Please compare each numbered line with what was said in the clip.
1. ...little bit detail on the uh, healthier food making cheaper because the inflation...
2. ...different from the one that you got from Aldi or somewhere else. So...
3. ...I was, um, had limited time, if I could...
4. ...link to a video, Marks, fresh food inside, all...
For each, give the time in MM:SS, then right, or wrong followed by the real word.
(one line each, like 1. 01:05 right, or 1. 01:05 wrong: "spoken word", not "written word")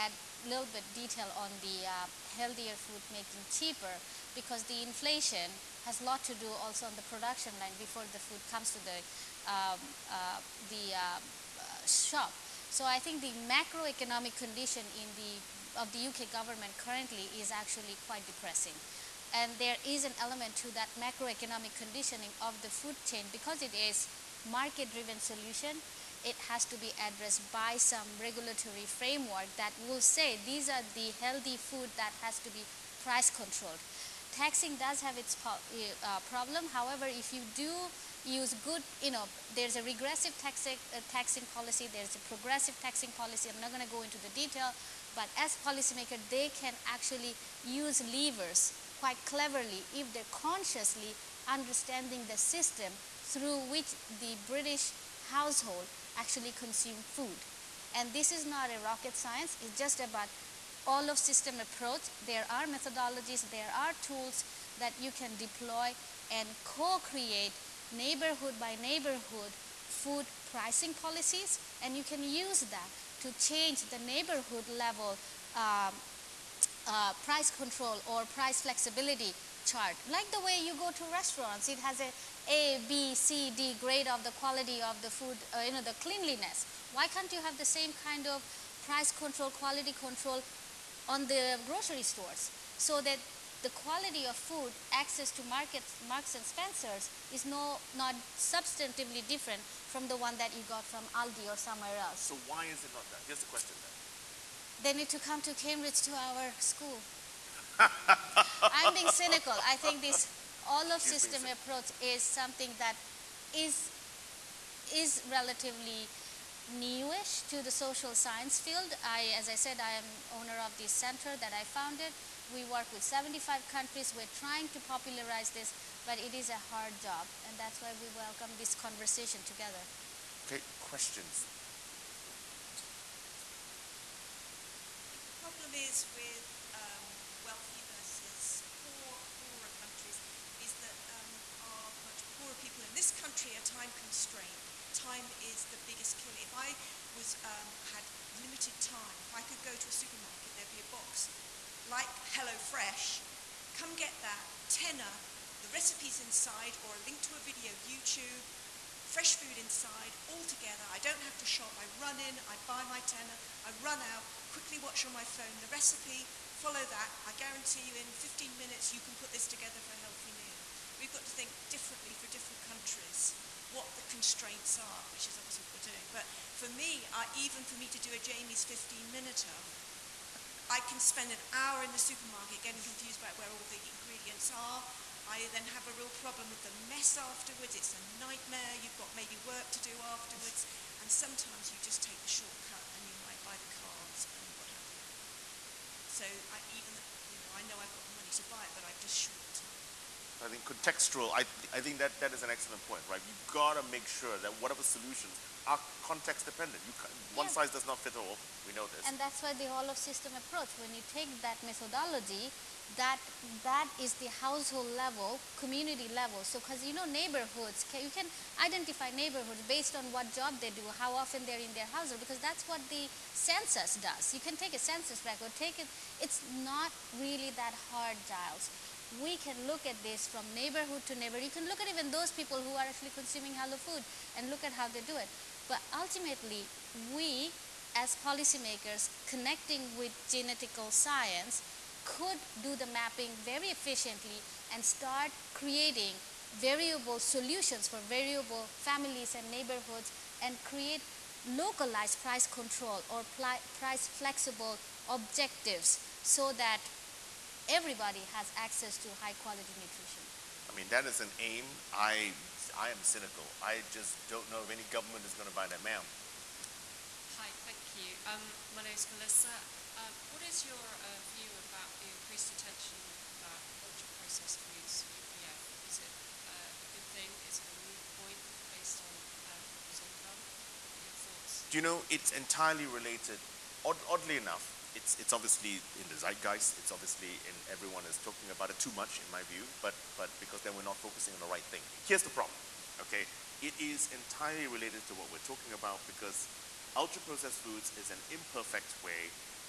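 1. 00:00 right
2. 01:39 right
3. 02:26 right
4. 02:37 wrong: "YouTube", not "Marks".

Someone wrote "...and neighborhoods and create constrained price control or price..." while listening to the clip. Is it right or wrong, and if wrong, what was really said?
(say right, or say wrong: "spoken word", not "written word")
wrong: "localized", not "constrained".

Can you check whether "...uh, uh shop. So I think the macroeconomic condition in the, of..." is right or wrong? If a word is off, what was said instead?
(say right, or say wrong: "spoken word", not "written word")
right.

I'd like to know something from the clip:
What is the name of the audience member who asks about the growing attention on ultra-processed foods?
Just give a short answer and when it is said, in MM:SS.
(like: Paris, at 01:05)
Melissa, at 04:29.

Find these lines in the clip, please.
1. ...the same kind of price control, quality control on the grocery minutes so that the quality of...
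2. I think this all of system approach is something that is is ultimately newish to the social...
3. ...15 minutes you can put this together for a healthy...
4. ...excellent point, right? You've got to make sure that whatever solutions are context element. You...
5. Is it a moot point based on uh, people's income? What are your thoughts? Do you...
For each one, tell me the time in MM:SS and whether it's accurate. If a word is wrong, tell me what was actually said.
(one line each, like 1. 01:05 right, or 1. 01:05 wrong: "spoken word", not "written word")
1. 01:27 wrong: "stores", not "minutes"
2. 01:49 wrong: "relatively", not "ultimately"
3. 02:48 right
4. 03:22 wrong: "dependent", not "element"
5. 04:37 right.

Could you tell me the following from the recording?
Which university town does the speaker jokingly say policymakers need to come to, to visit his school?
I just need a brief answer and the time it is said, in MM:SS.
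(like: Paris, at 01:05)
Cambridge, at 01:45.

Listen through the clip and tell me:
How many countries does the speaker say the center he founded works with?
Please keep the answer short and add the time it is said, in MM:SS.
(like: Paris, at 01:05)
75, at 02:03.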